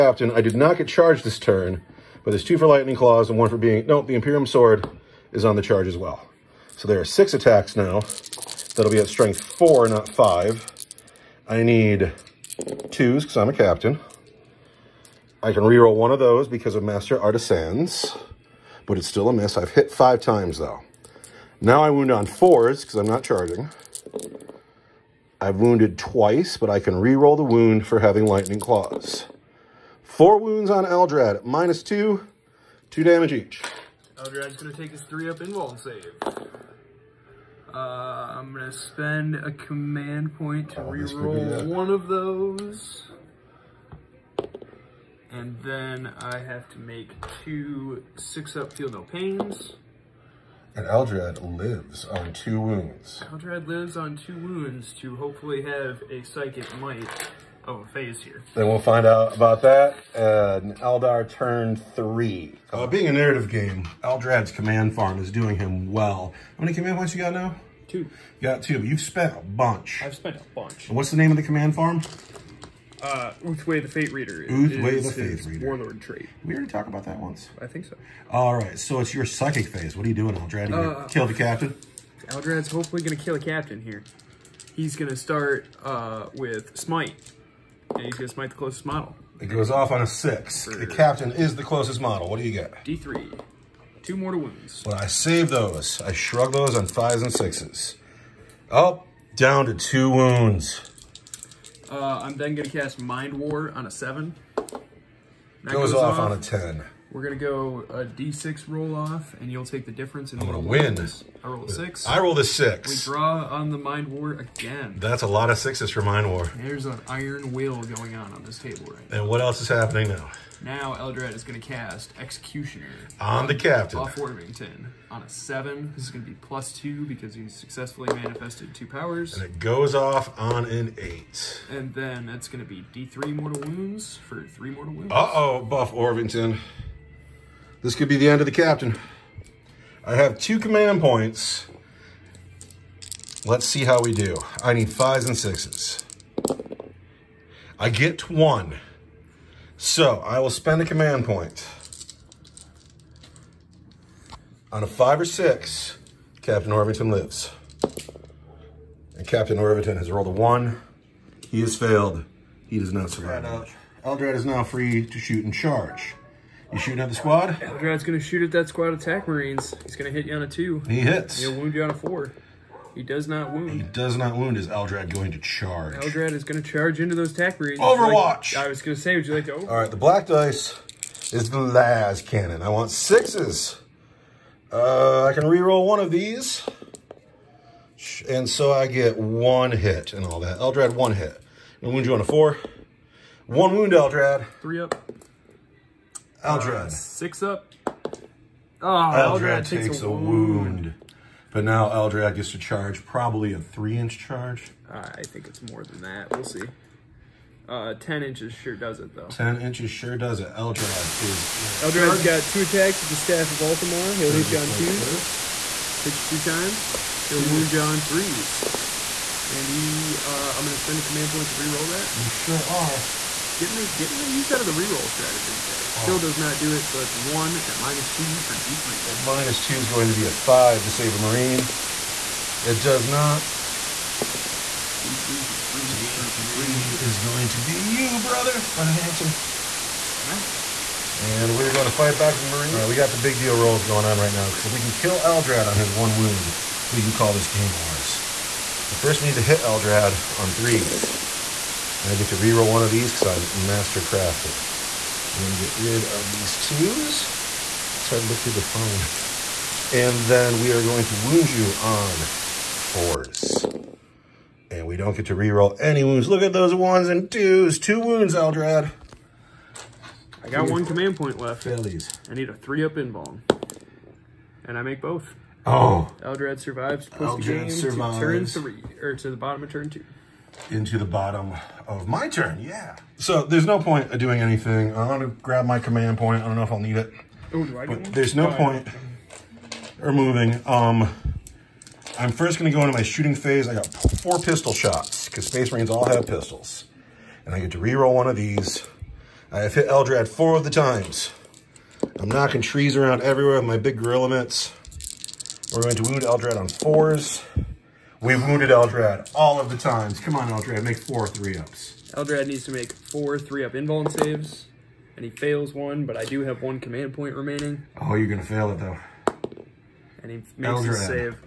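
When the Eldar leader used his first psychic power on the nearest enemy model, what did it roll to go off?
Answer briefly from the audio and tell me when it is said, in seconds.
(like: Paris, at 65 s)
6, at 89 s.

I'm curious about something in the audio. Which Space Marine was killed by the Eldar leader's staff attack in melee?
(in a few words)
Brother Hanson.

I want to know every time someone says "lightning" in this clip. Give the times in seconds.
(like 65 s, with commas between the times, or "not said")
2 s, 28 s.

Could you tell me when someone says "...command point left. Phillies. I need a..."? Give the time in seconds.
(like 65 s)
270 s.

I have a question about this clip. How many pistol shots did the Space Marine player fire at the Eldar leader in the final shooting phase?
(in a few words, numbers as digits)
4.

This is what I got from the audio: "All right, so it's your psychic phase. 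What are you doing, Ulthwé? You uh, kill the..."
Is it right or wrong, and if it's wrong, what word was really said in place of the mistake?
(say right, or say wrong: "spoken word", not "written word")
wrong: "Aldrad", not "Ulthwé".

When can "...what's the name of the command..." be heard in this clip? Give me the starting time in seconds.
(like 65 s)
70 s.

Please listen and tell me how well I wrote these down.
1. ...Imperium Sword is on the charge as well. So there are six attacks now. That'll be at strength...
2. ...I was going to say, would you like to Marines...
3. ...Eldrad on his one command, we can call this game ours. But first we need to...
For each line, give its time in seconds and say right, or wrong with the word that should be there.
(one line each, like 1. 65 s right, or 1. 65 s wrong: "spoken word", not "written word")
1. 4 s right
2. 178 s wrong: "All", not "Marines"
3. 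245 s wrong: "wound", not "command".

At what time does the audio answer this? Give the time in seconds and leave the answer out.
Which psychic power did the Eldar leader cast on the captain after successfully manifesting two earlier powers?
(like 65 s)
122 s.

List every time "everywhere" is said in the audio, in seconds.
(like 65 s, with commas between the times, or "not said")
303 s.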